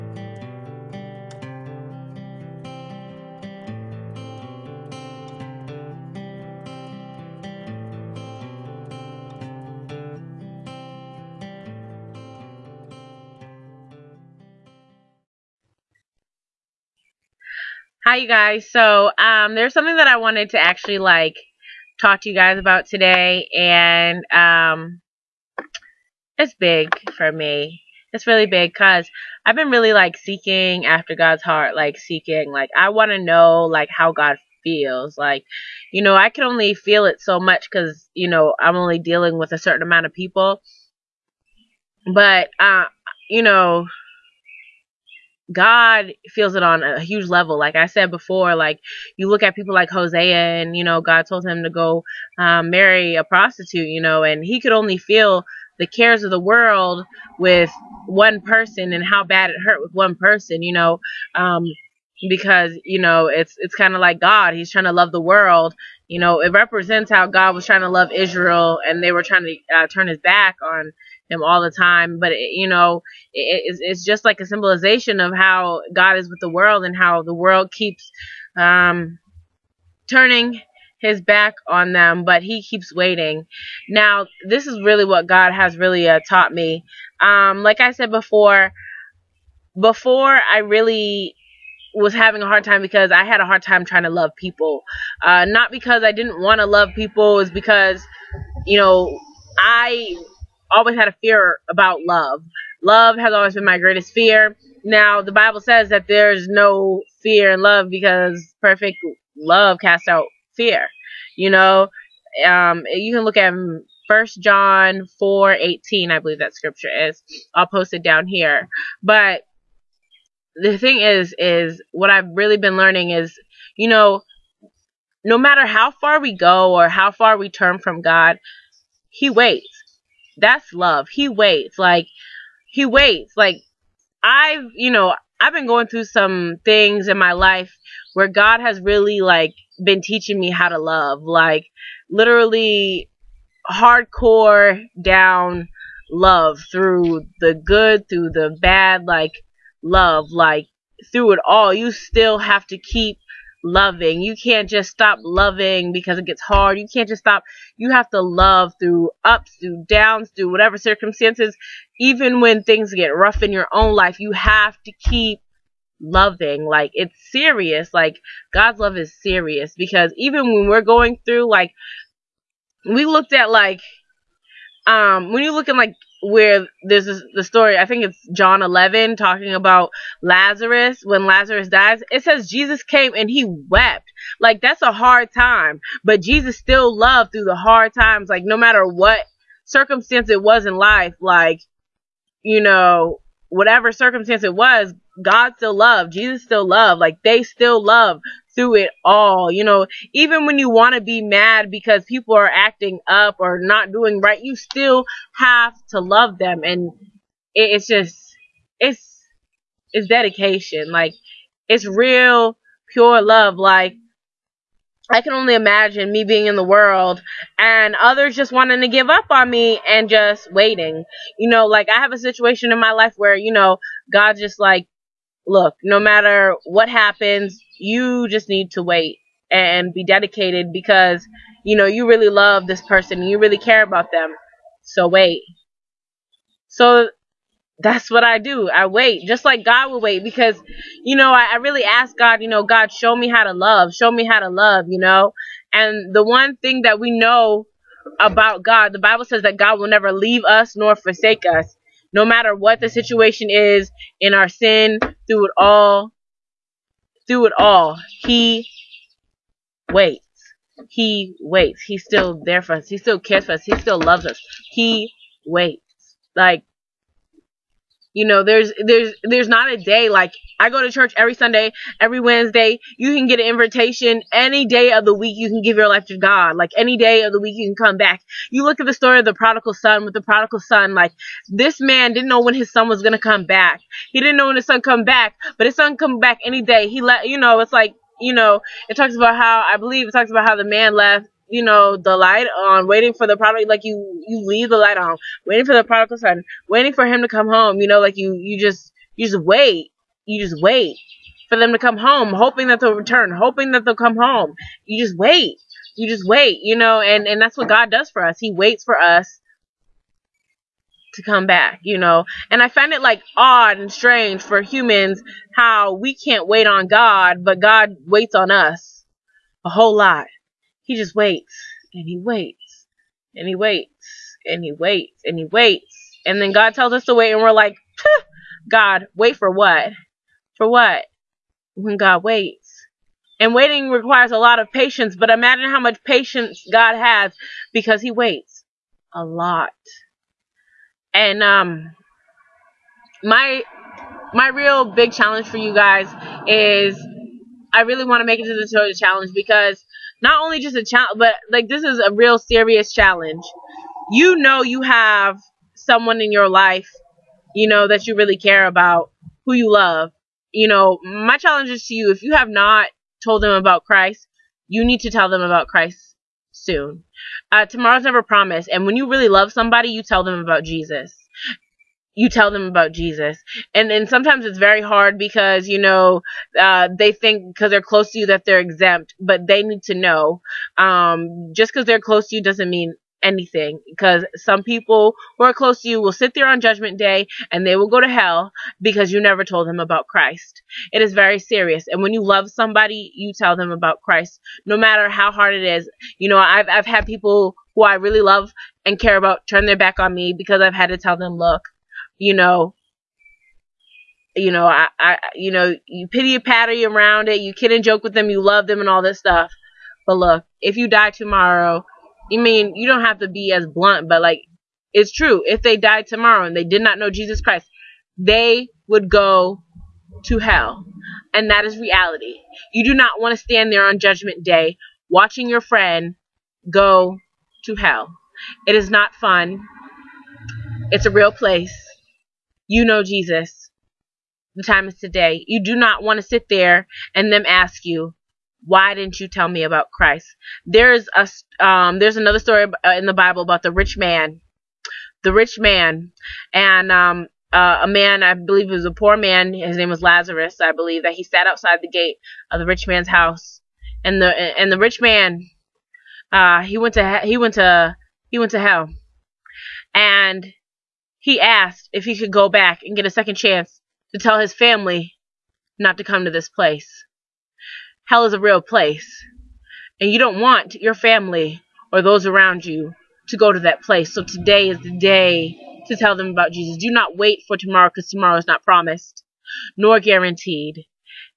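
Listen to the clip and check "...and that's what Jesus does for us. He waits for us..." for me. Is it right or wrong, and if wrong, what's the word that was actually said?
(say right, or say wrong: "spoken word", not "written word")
wrong: "God", not "Jesus".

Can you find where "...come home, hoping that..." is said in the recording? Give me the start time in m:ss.
5:01.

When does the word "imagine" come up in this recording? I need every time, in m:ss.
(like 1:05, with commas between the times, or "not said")
3:35, 5:35.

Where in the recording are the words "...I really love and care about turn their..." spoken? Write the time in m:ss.
6:37.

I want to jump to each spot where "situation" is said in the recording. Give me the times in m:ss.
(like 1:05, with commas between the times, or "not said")
3:42, 4:12.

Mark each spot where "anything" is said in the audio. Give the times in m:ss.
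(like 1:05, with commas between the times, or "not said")
6:23.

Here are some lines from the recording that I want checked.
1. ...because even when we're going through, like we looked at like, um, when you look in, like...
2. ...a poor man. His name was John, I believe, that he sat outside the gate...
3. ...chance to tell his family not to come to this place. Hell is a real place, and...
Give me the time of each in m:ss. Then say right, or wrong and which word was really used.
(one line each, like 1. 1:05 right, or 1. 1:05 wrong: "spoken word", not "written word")
1. 2:49 right
2. 7:28 wrong: "Lazarus", not "John"
3. 7:43 right.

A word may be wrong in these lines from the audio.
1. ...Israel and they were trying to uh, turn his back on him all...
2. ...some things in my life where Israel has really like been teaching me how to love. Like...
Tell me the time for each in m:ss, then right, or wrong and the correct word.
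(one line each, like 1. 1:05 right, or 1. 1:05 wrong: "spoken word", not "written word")
1. 1:08 right
2. 2:16 wrong: "God", not "Israel".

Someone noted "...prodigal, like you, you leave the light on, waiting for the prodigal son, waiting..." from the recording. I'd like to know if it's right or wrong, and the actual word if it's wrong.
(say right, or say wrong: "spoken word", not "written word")
right.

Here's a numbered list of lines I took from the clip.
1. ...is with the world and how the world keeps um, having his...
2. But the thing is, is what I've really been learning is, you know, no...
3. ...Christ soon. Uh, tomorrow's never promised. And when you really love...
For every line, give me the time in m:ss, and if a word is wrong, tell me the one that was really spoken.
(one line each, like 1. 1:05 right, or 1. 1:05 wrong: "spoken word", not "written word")
1. 1:16 wrong: "turning", not "having"
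2. 1:59 right
3. 6:05 right.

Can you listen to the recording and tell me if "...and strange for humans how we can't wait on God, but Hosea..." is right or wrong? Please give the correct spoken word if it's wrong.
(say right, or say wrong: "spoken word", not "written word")
wrong: "God", not "Hosea".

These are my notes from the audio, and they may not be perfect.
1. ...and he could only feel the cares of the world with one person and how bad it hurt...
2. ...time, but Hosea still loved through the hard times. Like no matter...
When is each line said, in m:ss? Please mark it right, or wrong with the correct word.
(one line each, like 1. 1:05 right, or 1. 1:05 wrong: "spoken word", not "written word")
1. 0:54 right
2. 3:05 wrong: "Jesus", not "Hosea".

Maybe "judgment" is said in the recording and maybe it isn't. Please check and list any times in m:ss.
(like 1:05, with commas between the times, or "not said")
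6:26, 7:03.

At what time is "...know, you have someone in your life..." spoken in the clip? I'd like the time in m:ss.
5:54.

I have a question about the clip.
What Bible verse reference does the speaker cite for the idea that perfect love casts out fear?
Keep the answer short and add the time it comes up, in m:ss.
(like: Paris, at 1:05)
First John 4:18, at 1:54.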